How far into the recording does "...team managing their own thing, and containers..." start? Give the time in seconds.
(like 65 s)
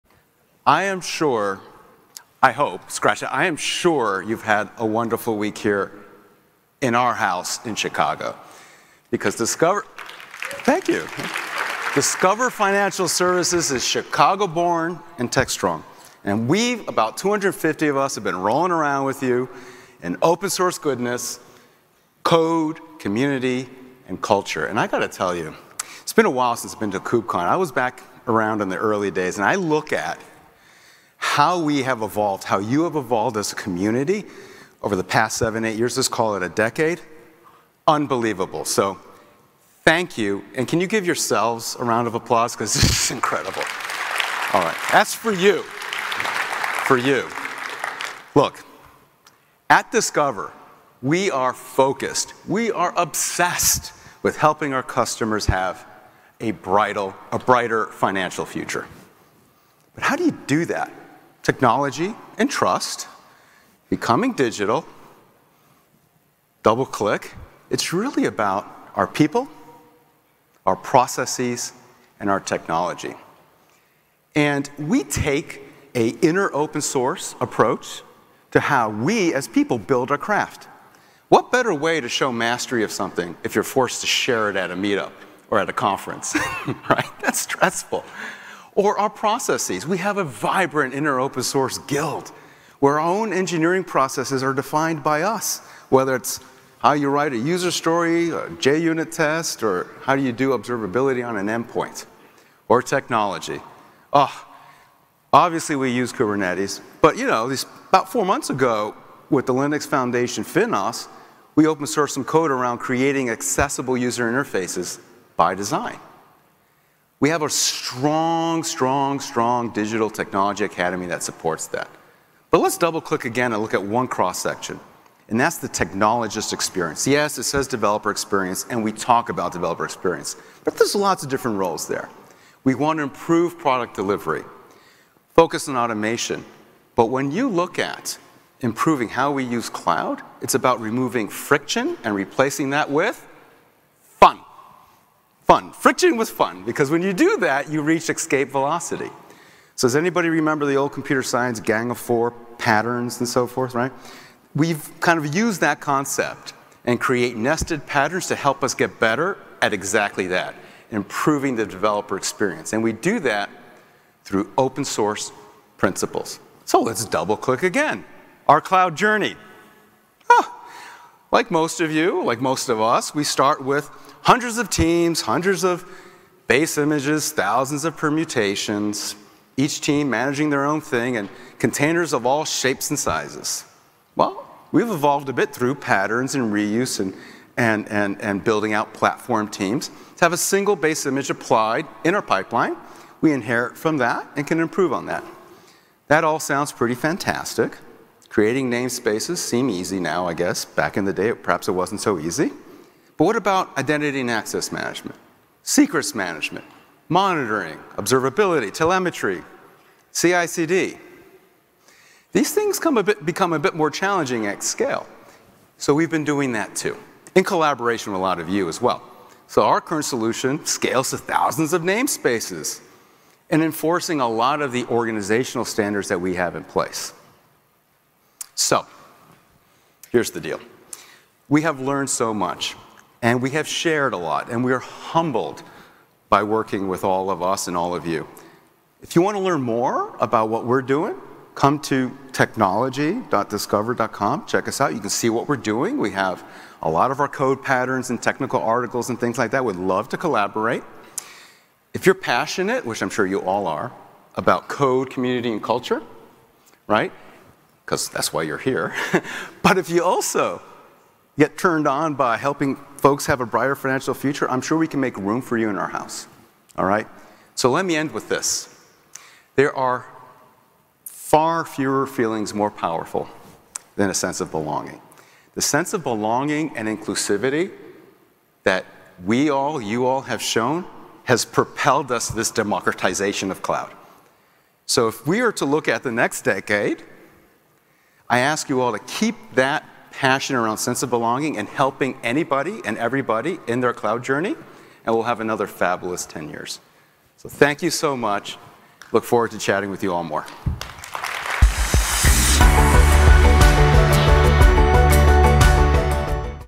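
179 s.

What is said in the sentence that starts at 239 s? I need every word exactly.
If you want to learn more about what we're doing, come to technology.discover.com.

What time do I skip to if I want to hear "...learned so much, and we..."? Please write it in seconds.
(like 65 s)
231 s.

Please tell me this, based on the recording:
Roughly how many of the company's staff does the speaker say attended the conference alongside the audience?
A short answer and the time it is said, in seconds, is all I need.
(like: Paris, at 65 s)
250, at 17 s.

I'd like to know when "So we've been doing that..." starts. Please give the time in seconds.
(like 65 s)
215 s.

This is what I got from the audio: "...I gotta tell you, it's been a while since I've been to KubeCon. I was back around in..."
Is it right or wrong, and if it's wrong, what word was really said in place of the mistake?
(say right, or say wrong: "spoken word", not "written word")
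right.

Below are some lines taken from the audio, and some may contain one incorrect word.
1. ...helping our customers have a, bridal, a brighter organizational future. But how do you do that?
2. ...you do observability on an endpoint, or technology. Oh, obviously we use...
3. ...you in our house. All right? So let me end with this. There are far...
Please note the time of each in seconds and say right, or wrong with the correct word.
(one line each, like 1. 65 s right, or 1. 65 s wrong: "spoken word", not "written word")
1. 54 s wrong: "financial", not "organizational"
2. 100 s right
3. 265 s right.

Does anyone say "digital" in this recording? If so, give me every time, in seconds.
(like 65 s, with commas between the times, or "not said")
64 s, 119 s.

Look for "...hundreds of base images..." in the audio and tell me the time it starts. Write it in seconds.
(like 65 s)
175 s.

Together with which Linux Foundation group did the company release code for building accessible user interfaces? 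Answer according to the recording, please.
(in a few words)
FinOS.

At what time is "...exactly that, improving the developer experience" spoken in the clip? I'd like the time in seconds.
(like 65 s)
159 s.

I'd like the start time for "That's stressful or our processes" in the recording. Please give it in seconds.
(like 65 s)
87 s.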